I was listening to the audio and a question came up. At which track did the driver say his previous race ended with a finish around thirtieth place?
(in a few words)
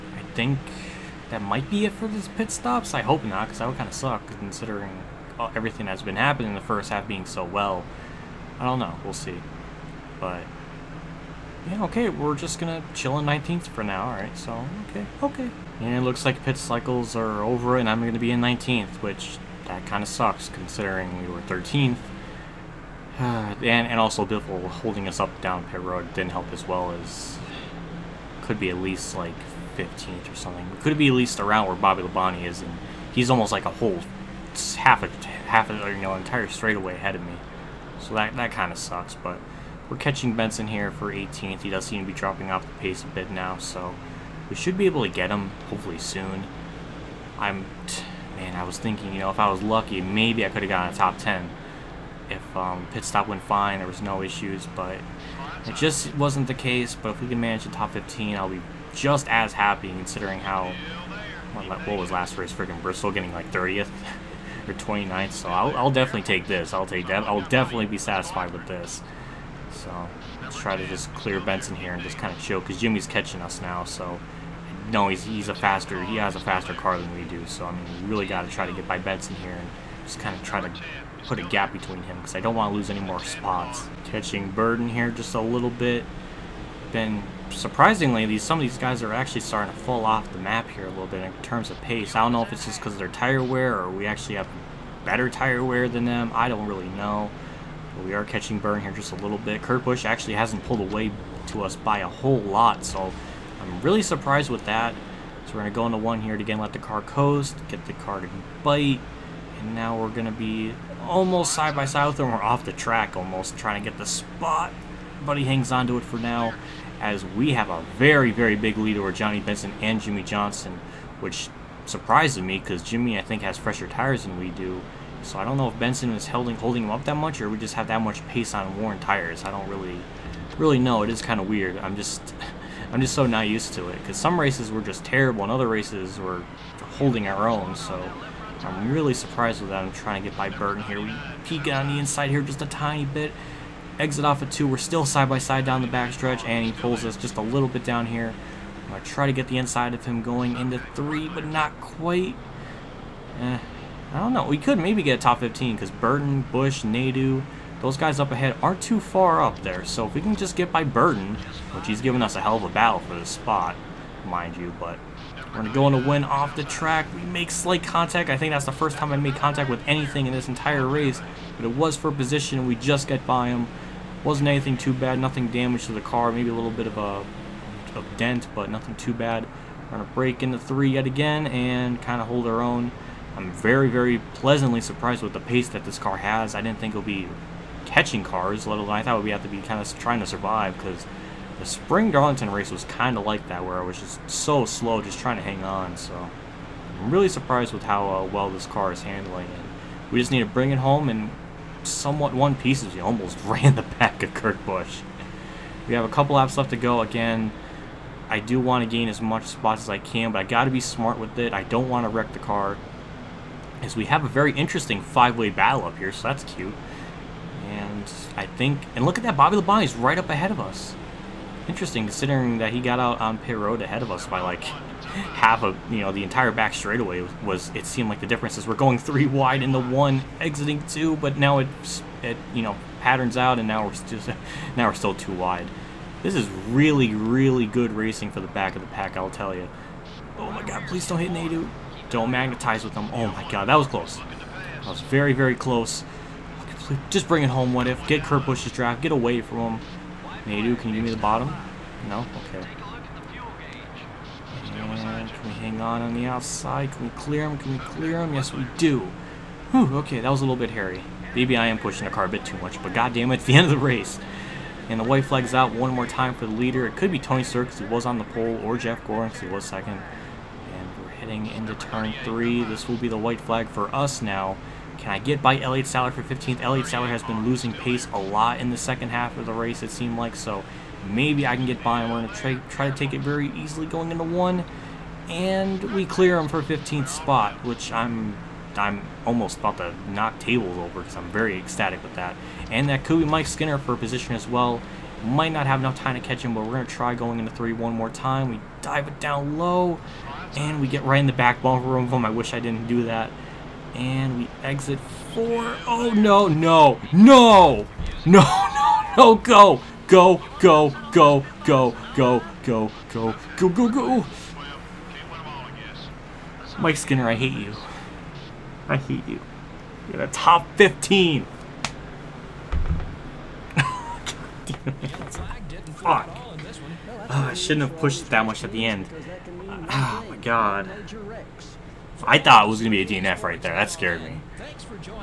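Bristol.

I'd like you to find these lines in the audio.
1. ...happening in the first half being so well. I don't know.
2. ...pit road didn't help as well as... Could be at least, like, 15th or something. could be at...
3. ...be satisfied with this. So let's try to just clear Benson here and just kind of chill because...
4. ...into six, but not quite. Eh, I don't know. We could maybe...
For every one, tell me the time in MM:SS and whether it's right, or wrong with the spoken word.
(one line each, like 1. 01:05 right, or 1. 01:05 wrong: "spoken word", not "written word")
1. 00:06 right
2. 00:25 right
3. 01:07 right
4. 02:30 wrong: "three", not "six".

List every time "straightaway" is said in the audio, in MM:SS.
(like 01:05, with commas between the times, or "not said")
00:36, 03:46.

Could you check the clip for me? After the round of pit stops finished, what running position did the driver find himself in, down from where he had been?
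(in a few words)
19th.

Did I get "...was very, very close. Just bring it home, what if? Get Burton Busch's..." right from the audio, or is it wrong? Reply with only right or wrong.
wrong.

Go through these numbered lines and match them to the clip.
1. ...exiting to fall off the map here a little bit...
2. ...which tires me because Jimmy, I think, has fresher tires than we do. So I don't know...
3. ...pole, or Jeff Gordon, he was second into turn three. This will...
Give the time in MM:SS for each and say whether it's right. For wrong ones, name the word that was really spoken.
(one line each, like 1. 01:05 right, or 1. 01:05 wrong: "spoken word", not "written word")
1. 01:29 wrong: "starting", not "exiting"
2. 02:01 wrong: "surprises", not "tires"
3. 04:28 right.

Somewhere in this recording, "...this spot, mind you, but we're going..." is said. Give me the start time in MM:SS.
02:43.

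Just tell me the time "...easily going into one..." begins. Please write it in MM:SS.
04:43.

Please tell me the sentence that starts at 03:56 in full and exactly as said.
This is really, really good racing for the back of the pack, I'll tell you.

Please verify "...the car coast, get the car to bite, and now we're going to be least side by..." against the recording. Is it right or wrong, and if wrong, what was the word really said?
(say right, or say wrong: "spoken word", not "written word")
wrong: "almost", not "least".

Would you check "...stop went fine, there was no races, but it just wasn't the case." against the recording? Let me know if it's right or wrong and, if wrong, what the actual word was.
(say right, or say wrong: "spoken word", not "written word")
wrong: "issues", not "races".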